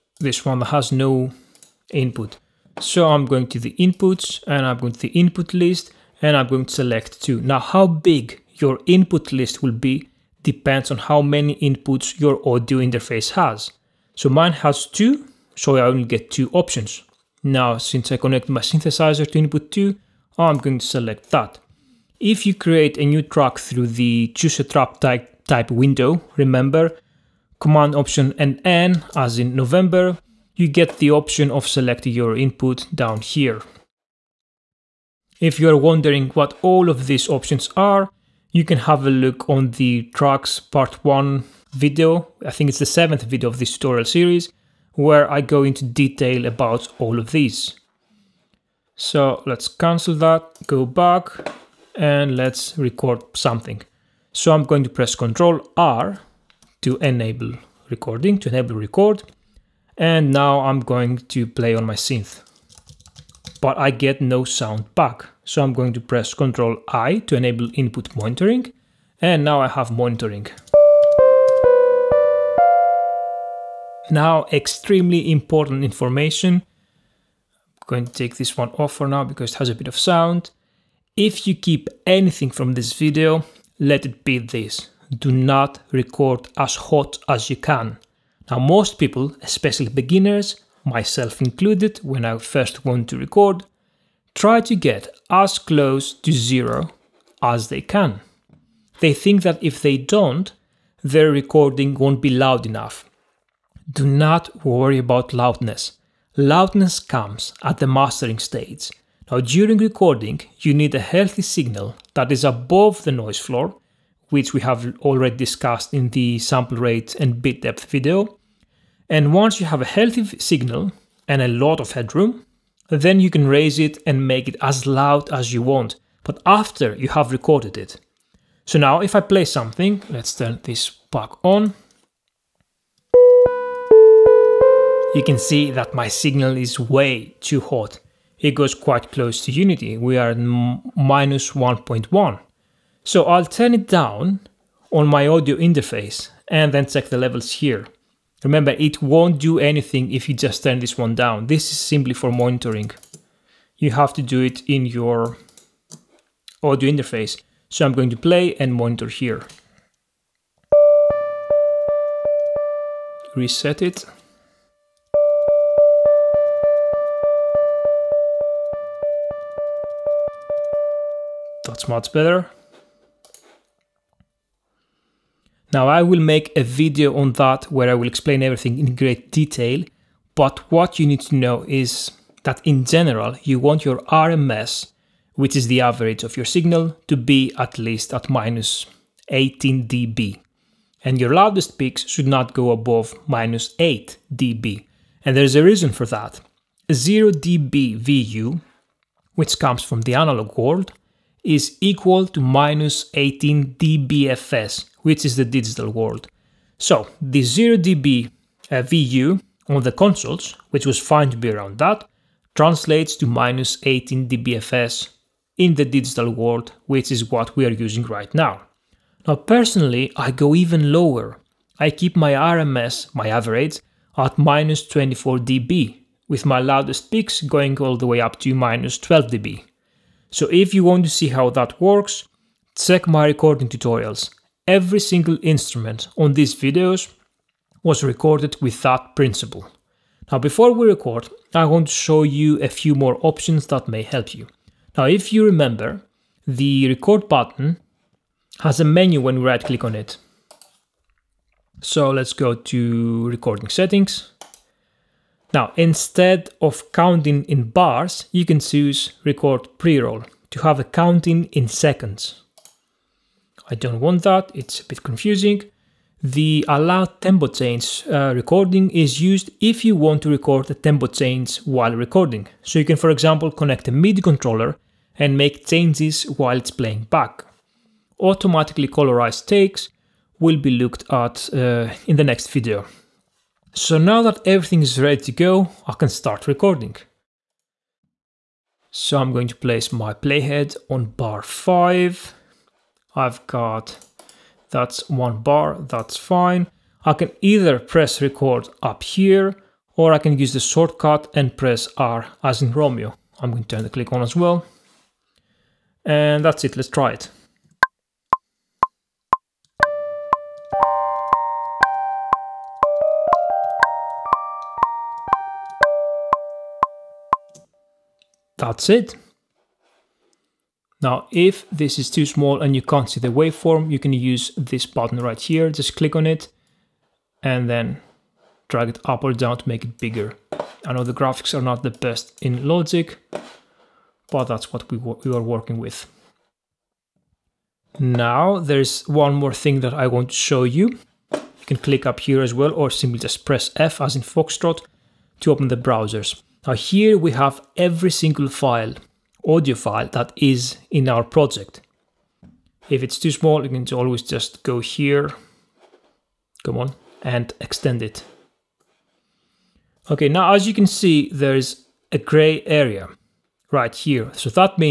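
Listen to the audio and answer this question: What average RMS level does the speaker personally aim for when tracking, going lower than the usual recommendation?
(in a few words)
-24 dB.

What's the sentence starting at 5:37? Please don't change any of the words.
Now, there's one more thing that I want to show you.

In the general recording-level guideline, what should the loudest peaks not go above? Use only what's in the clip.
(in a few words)
-8 dB.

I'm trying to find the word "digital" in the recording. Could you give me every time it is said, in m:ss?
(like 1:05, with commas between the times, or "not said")
3:25, 3:35.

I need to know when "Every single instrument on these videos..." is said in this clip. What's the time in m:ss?
3:54.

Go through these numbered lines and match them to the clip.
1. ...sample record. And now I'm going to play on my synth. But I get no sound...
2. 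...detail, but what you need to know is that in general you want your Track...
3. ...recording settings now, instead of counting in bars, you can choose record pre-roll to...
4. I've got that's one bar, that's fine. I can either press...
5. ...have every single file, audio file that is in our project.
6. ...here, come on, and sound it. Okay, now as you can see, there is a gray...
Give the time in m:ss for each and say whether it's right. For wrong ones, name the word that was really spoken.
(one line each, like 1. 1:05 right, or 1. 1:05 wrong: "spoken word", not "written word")
1. 0:58 wrong: "enable", not "sample"
2. 2:59 wrong: "RMS", not "Track"
3. 4:13 right
4. 4:53 right
5. 5:47 right
6. 5:54 wrong: "extend", not "sound".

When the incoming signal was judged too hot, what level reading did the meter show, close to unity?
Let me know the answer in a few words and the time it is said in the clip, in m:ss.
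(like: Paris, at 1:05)
-1.1, at 2:20.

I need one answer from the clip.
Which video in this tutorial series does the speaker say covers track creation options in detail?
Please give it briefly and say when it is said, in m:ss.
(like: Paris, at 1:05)
7th, at 0:42.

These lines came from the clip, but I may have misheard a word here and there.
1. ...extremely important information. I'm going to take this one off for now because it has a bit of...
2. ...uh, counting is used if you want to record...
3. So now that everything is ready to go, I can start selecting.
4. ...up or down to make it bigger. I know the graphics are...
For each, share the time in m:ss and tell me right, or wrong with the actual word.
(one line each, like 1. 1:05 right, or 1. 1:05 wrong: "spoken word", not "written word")
1. 1:14 right
2. 4:28 wrong: "recording", not "counting"
3. 4:43 wrong: "recording", not "selecting"
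4. 5:29 right.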